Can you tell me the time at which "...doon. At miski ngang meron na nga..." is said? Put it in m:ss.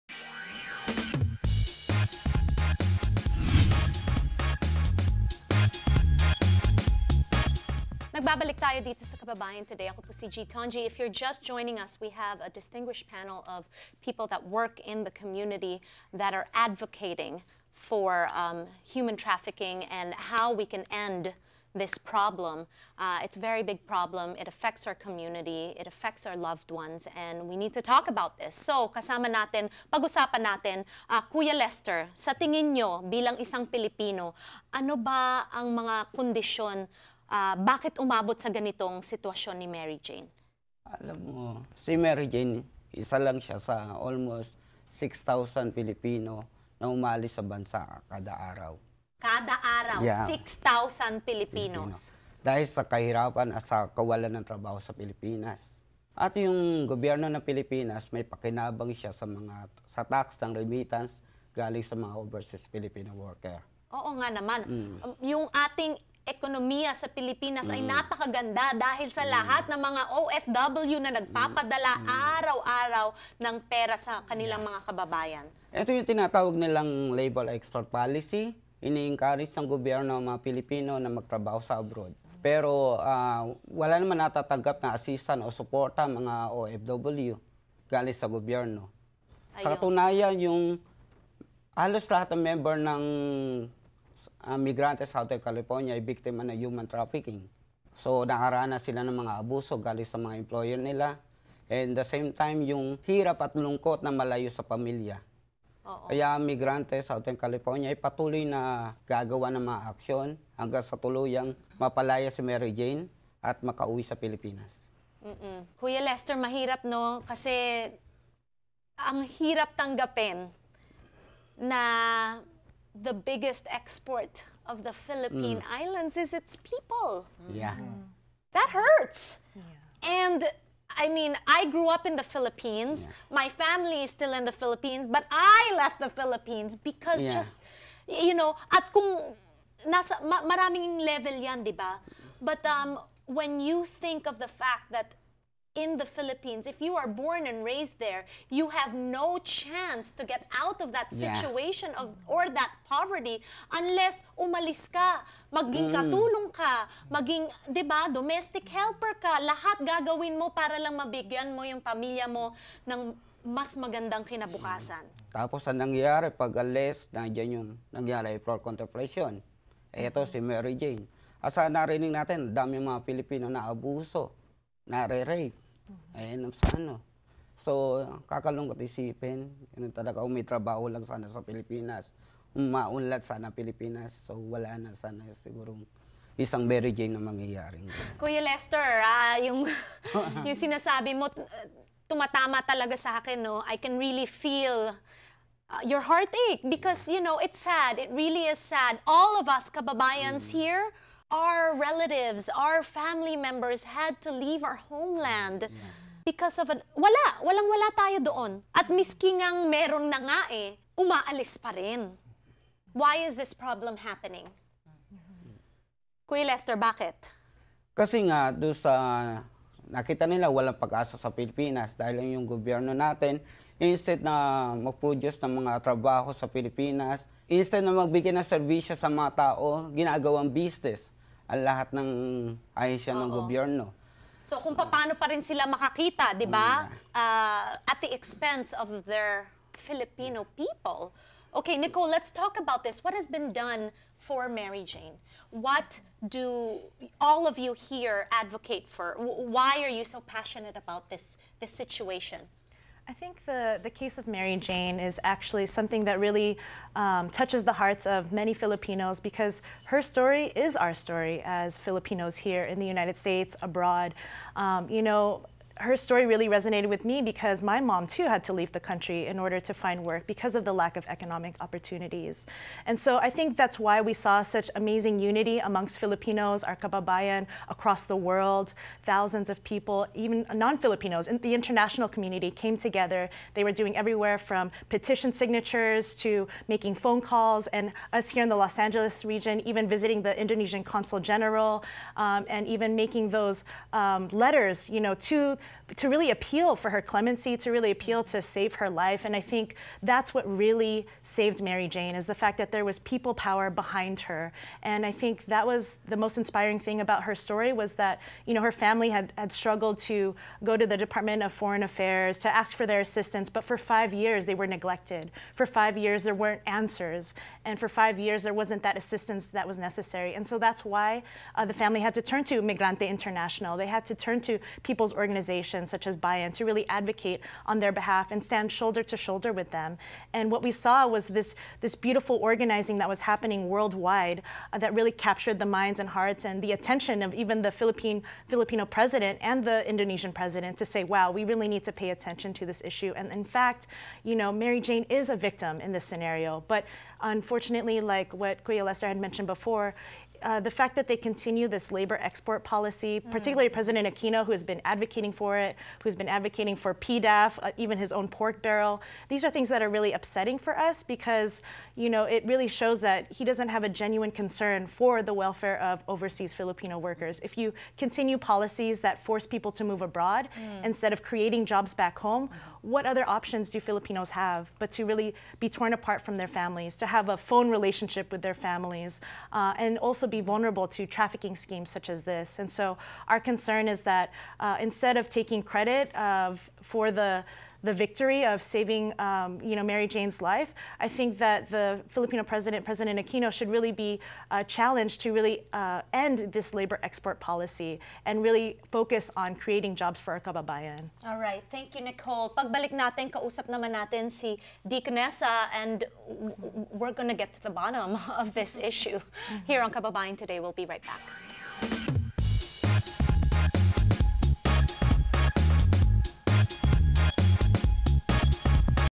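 3:28.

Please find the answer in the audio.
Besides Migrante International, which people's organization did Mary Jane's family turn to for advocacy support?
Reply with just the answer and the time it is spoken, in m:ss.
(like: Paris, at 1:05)
BAYAN, at 5:26.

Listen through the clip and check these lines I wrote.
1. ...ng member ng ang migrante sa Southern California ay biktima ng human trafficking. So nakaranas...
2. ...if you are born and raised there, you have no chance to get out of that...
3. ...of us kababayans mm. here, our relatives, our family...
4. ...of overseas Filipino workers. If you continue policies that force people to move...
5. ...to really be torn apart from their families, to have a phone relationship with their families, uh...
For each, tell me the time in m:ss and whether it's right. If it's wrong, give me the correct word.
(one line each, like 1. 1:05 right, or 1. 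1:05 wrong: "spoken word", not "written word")
1. 1:32 right
2. 2:26 right
3. 3:19 right
4. 6:05 right
5. 6:14 right.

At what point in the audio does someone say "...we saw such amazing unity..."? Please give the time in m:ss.
4:34.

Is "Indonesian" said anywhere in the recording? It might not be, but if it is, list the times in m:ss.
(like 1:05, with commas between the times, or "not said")
4:50, 5:39.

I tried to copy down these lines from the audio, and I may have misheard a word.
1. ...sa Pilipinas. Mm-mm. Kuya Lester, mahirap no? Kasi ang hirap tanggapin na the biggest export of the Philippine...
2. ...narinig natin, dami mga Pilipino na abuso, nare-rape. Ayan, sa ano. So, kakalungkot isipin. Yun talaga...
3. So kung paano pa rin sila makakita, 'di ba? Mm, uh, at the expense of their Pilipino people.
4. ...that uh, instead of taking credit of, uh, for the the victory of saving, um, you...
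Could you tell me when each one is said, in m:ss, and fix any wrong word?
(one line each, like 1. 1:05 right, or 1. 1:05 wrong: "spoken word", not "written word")
1. 1:54 right
2. 2:51 right
3. 3:54 wrong: "Filipino", not "Pilipino"
4. 6:24 right.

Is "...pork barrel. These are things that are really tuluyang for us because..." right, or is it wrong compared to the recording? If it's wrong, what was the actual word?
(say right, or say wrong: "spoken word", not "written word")
wrong: "upsetting", not "tuluyang".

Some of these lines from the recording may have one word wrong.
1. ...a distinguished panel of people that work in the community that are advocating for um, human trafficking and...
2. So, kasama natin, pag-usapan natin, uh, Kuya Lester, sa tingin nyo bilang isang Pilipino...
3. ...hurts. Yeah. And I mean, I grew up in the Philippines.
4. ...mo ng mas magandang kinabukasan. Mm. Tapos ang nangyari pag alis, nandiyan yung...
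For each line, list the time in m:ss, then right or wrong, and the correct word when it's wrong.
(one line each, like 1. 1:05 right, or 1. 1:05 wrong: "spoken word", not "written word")
1. 0:12 right
2. 0:28 right
3. 2:08 right
4. 2:42 right.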